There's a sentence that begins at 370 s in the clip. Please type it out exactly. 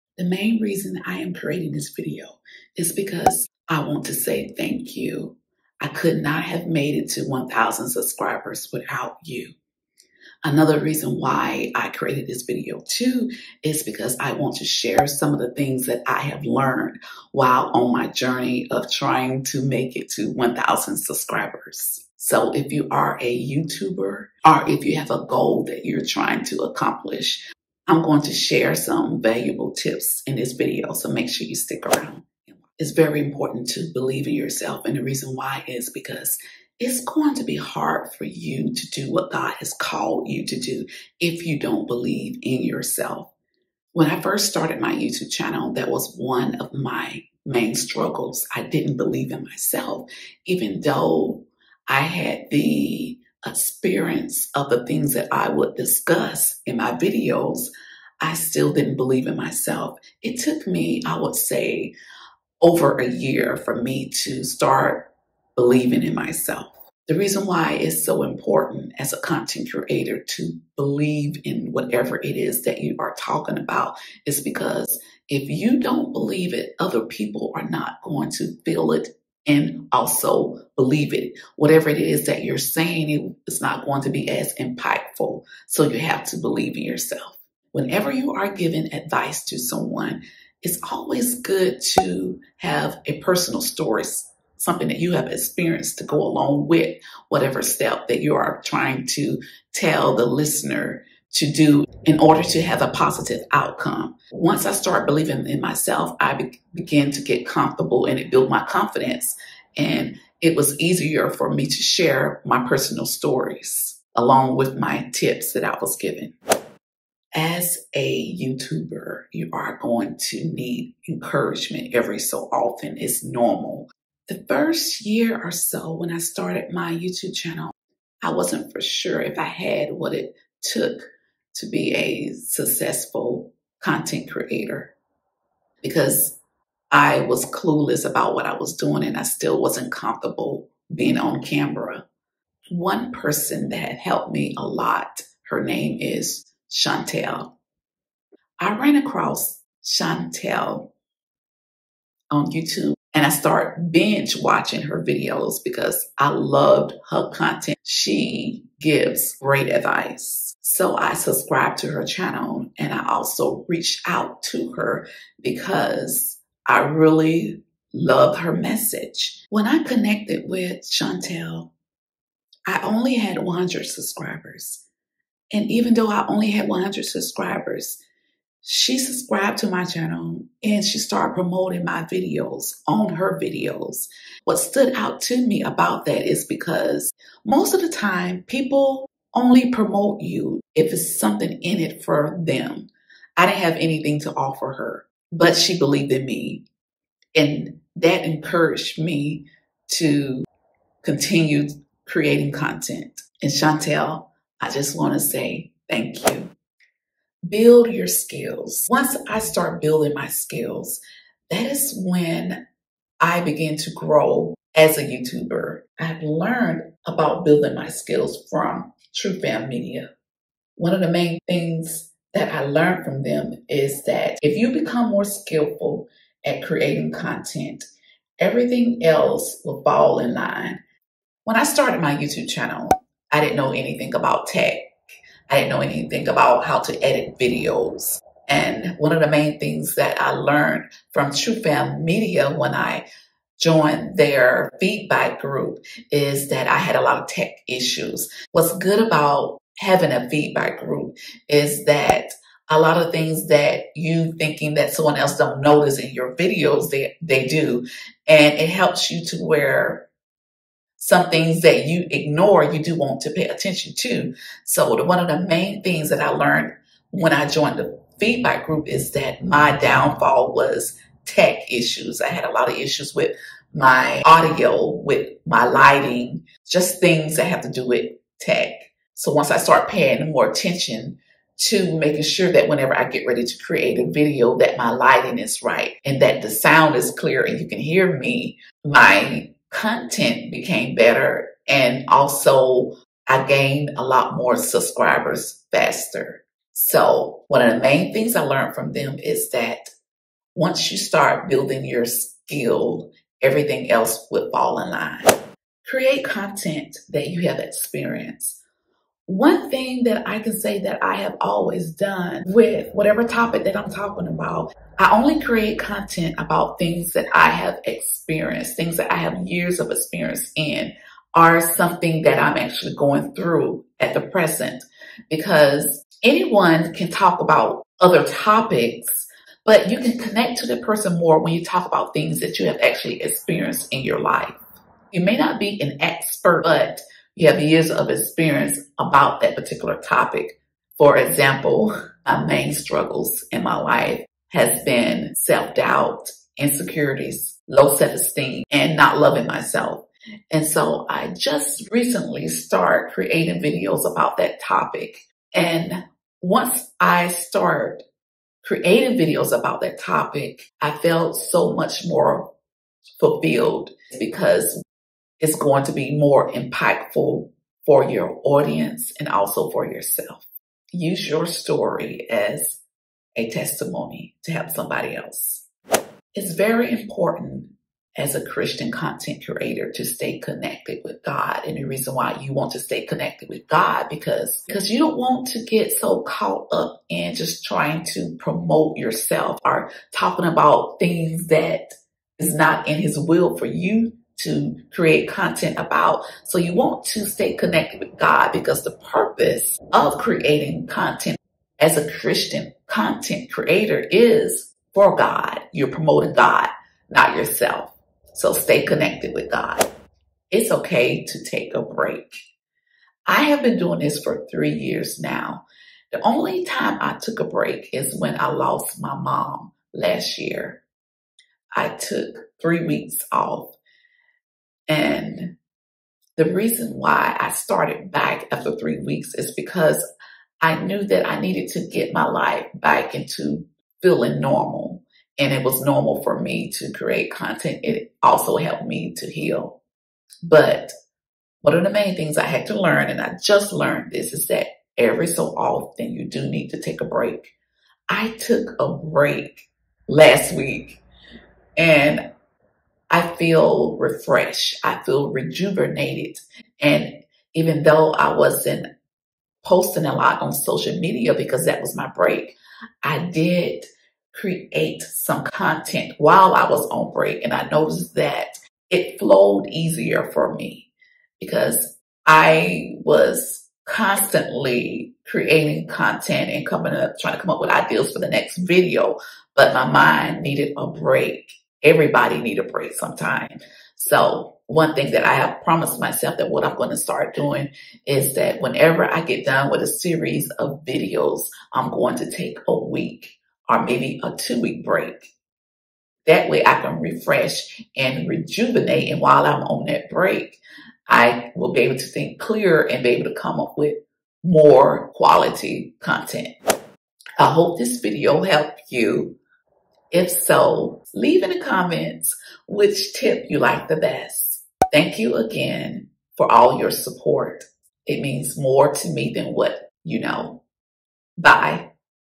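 Use your story as a testimony to help somebody else.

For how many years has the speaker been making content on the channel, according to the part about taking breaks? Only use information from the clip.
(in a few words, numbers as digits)
3.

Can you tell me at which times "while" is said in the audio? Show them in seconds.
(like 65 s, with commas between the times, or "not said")
17 s, 466 s, 499 s.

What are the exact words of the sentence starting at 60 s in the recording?
It took me, I would say, over a year for me to start believing in myself.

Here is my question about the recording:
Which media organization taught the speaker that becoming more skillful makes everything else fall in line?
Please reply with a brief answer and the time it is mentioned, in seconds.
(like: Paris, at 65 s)
Truthbound Media, at 219 s.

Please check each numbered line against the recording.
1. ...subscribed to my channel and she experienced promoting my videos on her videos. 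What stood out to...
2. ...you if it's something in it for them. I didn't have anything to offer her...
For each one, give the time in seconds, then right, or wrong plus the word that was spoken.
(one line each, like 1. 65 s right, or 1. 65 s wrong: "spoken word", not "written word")
1. 178 s wrong: "started", not "experienced"
2. 190 s right.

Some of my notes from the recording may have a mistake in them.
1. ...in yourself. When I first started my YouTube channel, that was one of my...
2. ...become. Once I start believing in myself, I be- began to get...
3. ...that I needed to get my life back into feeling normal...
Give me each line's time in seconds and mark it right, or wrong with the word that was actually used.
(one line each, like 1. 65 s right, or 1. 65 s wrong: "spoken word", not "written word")
1. 42 s right
2. 103 s wrong: "outcome", not "become"
3. 431 s right.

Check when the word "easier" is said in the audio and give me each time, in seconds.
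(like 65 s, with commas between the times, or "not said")
110 s, 469 s.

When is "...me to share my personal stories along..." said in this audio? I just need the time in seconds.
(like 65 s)
111 s.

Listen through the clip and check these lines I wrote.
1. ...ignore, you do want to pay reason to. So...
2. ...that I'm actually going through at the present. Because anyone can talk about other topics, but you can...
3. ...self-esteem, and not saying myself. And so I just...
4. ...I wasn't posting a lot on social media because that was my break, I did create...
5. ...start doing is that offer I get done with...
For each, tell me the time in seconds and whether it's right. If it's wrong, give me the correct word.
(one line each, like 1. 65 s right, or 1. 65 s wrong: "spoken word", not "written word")
1. 262 s wrong: "attention", not "reason"
2. 322 s right
3. 347 s wrong: "loving", not "saying"
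4. 458 s right
5. 486 s wrong: "whenever", not "offer".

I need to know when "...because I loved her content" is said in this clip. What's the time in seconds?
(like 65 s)
155 s.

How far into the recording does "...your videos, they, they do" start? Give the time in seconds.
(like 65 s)
256 s.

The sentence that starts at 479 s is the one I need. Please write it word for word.
But my mind needed a break.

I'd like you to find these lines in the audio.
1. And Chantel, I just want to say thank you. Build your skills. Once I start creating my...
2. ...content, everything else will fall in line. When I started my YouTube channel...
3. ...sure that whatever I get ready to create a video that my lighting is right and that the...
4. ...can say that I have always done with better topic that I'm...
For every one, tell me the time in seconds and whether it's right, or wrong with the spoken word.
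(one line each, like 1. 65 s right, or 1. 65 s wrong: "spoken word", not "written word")
1. 203 s wrong: "building", not "creating"
2. 227 s right
3. 282 s wrong: "whenever", not "whatever"
4. 310 s wrong: "whatever", not "better".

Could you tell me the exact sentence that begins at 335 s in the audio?
You may not be an expert, but you have years of experience about that particular topic.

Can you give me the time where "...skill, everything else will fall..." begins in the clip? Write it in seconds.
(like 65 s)
302 s.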